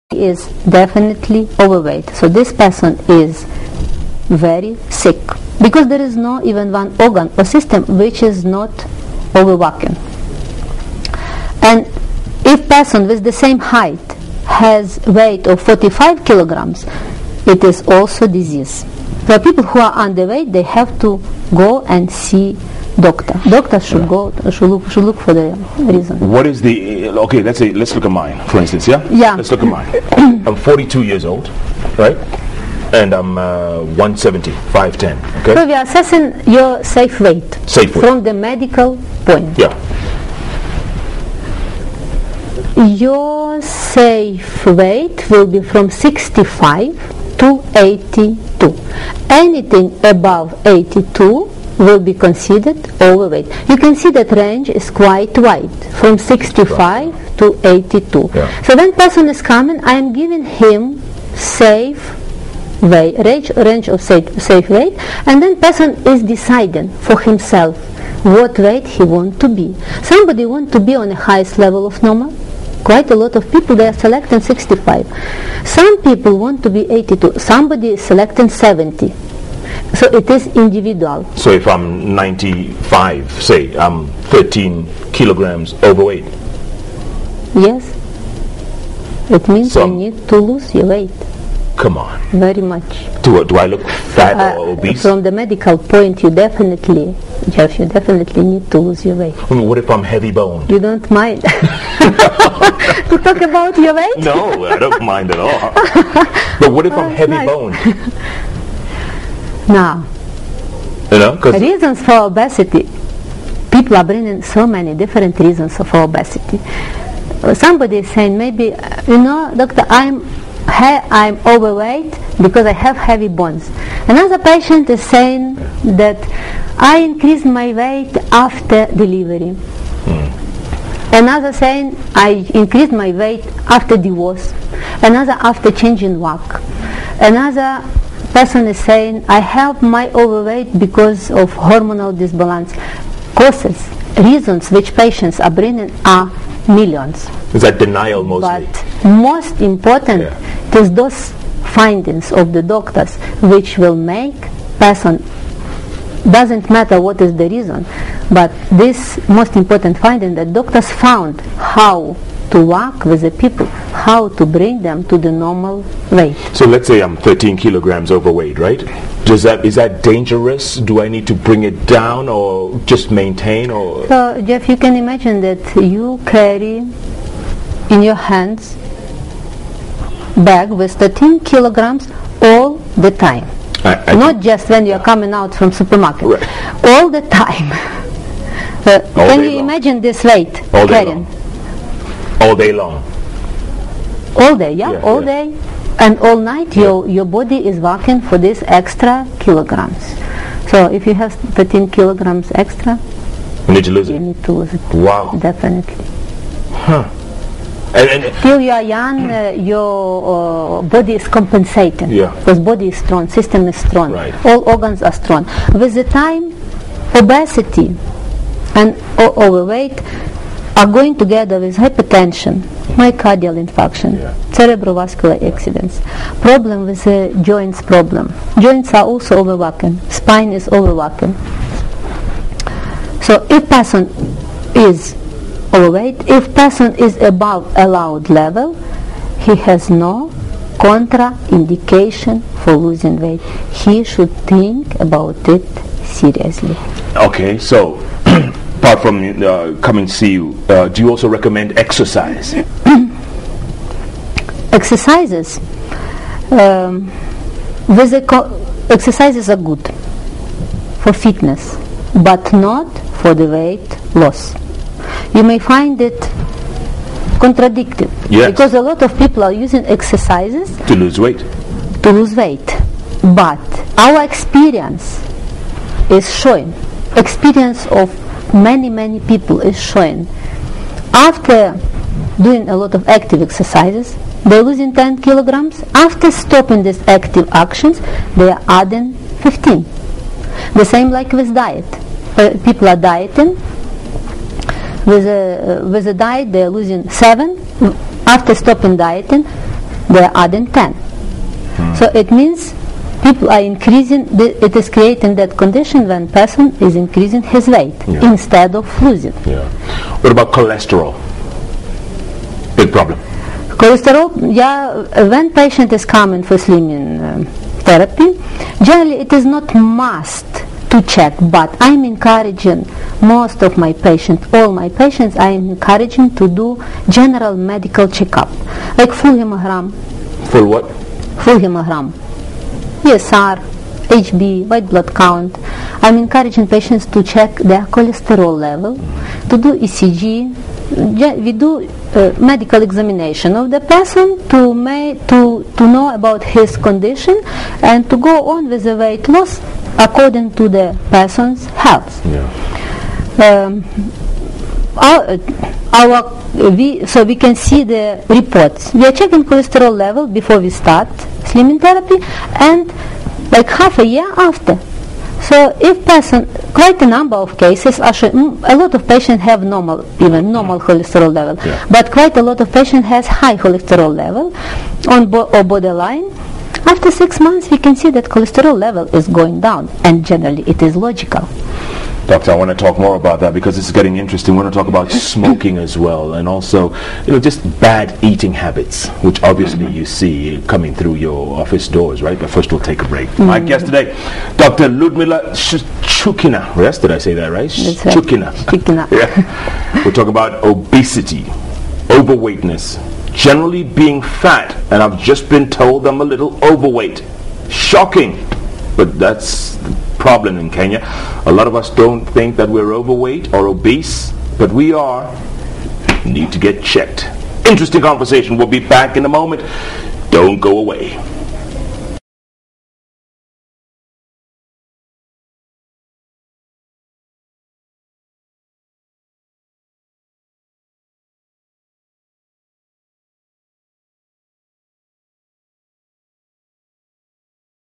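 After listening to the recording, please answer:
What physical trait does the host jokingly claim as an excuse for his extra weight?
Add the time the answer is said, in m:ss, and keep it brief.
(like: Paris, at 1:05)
heavy boned, at 1:40.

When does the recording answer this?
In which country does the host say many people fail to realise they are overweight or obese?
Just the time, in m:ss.
6:50.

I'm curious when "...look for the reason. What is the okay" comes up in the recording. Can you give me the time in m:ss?
0:25.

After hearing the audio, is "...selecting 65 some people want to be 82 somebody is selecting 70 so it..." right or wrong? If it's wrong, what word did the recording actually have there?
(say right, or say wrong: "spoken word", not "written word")
right.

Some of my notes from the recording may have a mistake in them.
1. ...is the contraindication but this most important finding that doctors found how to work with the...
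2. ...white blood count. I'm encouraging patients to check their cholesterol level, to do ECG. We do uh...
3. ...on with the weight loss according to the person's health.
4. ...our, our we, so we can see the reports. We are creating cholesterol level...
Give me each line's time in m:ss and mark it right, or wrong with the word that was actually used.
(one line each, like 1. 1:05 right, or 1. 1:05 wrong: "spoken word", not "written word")
1. 2:37 wrong: "reason", not "contraindication"
2. 5:34 right
3. 5:48 right
4. 5:54 wrong: "checking", not "creating".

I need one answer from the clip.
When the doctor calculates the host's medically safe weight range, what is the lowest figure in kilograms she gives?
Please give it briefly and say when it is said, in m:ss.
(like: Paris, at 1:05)
65, at 0:42.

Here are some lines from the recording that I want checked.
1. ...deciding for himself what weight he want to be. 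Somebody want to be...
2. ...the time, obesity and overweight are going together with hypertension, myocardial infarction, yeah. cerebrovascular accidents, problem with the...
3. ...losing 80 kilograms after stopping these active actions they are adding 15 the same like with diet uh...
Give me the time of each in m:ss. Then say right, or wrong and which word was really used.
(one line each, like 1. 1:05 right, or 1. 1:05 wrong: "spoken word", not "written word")
1. 1:06 right
2. 3:35 right
3. 4:44 wrong: "10", not "80".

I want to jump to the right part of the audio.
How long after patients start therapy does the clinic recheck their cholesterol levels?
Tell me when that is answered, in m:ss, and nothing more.
6:03.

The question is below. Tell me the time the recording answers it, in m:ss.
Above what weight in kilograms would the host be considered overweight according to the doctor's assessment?
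0:49.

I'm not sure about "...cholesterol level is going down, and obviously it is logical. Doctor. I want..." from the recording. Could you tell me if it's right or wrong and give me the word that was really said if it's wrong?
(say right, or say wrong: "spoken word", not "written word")
wrong: "generally", not "obviously".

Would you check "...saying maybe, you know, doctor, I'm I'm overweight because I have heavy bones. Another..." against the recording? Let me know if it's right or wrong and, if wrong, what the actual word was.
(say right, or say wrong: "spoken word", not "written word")
right.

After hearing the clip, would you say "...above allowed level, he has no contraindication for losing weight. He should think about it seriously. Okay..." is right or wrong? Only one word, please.
right.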